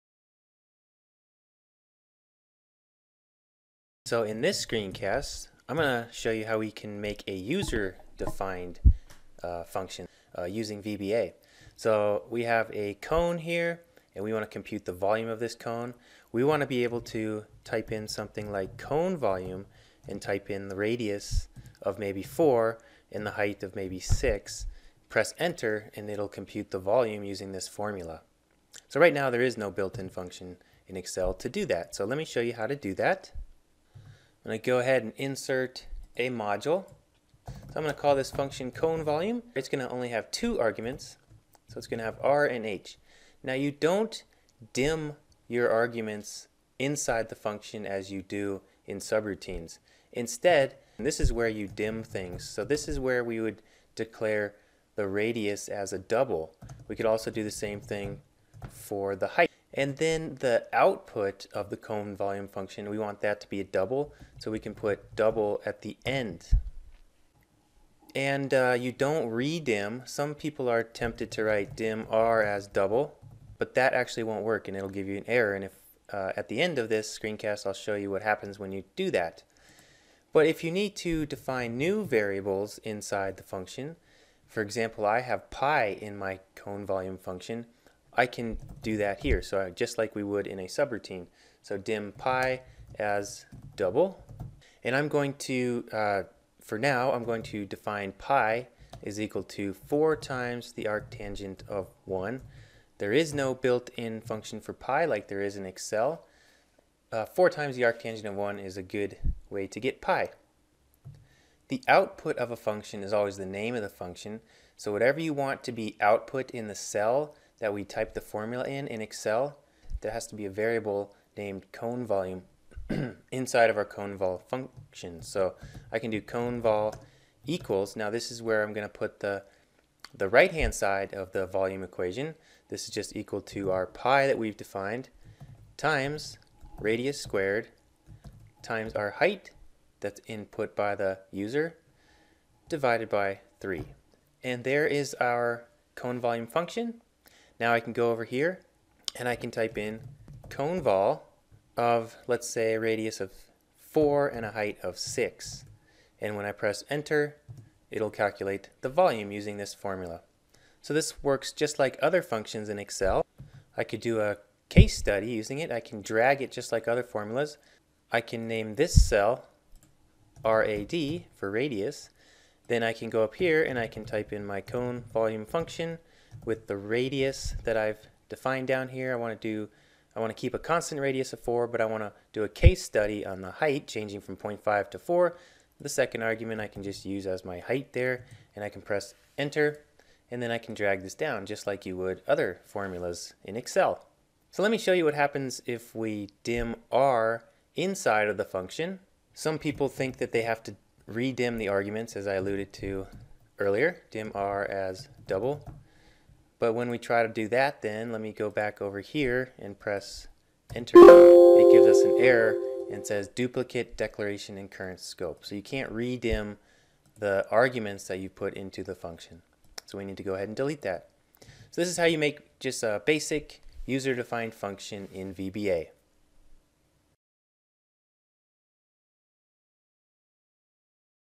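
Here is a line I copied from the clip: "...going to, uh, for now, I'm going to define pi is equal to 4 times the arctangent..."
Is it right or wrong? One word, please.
right.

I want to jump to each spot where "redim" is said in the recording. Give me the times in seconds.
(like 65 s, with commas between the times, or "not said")
69 s, 201 s, 215 s.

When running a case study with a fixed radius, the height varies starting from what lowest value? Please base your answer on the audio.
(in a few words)
0.5.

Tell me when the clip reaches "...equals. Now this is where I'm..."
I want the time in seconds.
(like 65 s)
127 s.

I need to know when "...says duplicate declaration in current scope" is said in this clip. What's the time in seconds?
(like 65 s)
213 s.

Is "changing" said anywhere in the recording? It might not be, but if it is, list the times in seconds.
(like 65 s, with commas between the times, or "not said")
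183 s.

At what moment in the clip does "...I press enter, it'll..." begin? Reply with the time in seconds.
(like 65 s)
156 s.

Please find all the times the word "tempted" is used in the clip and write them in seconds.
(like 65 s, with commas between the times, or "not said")
70 s.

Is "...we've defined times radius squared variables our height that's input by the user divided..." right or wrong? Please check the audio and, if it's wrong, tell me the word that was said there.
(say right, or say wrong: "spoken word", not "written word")
wrong: "times", not "variables".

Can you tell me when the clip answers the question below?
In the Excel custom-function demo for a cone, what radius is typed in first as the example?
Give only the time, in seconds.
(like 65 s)
20 s.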